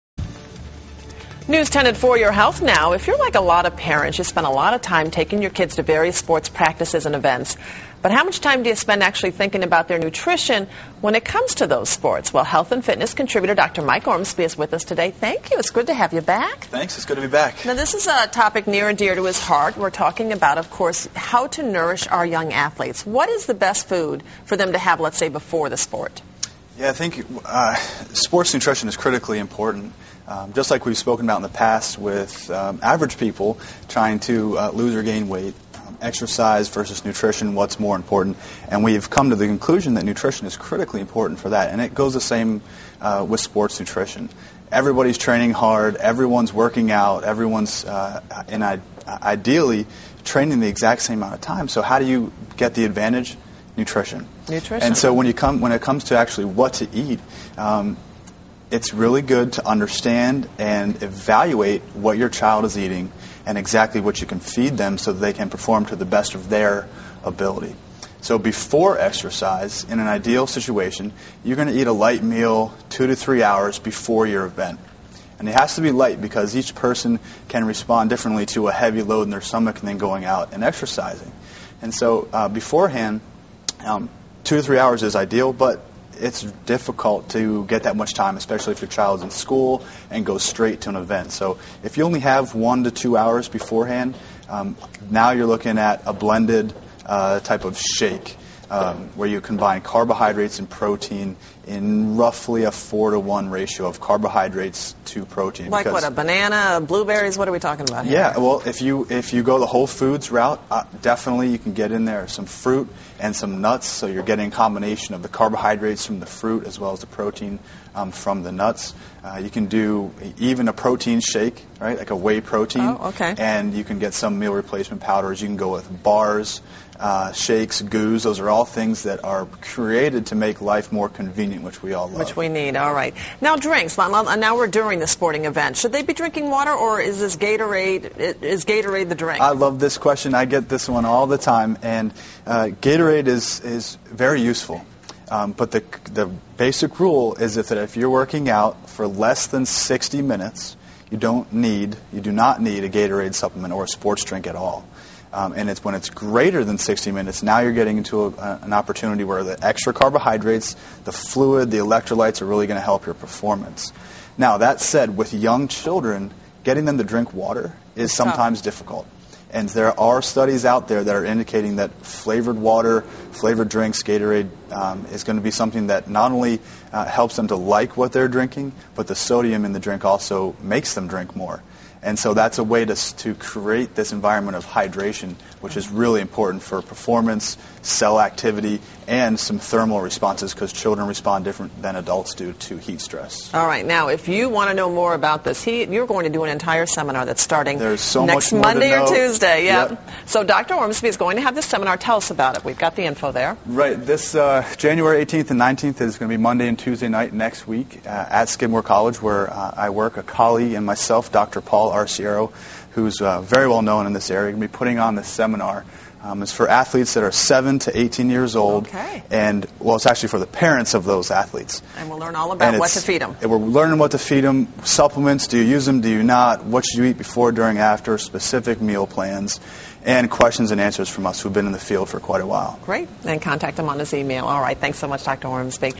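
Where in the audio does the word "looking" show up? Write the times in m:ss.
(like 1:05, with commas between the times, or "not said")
1:35.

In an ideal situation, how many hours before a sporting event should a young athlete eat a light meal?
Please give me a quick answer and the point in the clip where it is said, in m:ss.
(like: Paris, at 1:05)
2 to 3 hours, at 1:12.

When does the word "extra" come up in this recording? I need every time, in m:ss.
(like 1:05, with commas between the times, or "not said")
2:39.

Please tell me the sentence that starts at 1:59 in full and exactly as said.
Uh, you can do even a protein shake, right?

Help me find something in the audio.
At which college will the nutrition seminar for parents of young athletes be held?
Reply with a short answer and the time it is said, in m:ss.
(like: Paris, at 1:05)
Skidmore College, at 3:28.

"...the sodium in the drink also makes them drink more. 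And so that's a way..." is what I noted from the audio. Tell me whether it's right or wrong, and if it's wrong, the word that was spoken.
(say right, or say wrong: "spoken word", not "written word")
right.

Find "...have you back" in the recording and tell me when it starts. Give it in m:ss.
0:15.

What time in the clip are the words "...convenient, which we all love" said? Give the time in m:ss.
2:11.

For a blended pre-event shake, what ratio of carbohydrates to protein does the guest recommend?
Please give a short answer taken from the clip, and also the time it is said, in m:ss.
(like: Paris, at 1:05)
4 to 1, at 1:42.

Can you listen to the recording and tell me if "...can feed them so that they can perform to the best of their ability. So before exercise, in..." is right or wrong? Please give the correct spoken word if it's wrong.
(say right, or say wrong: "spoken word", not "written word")
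right.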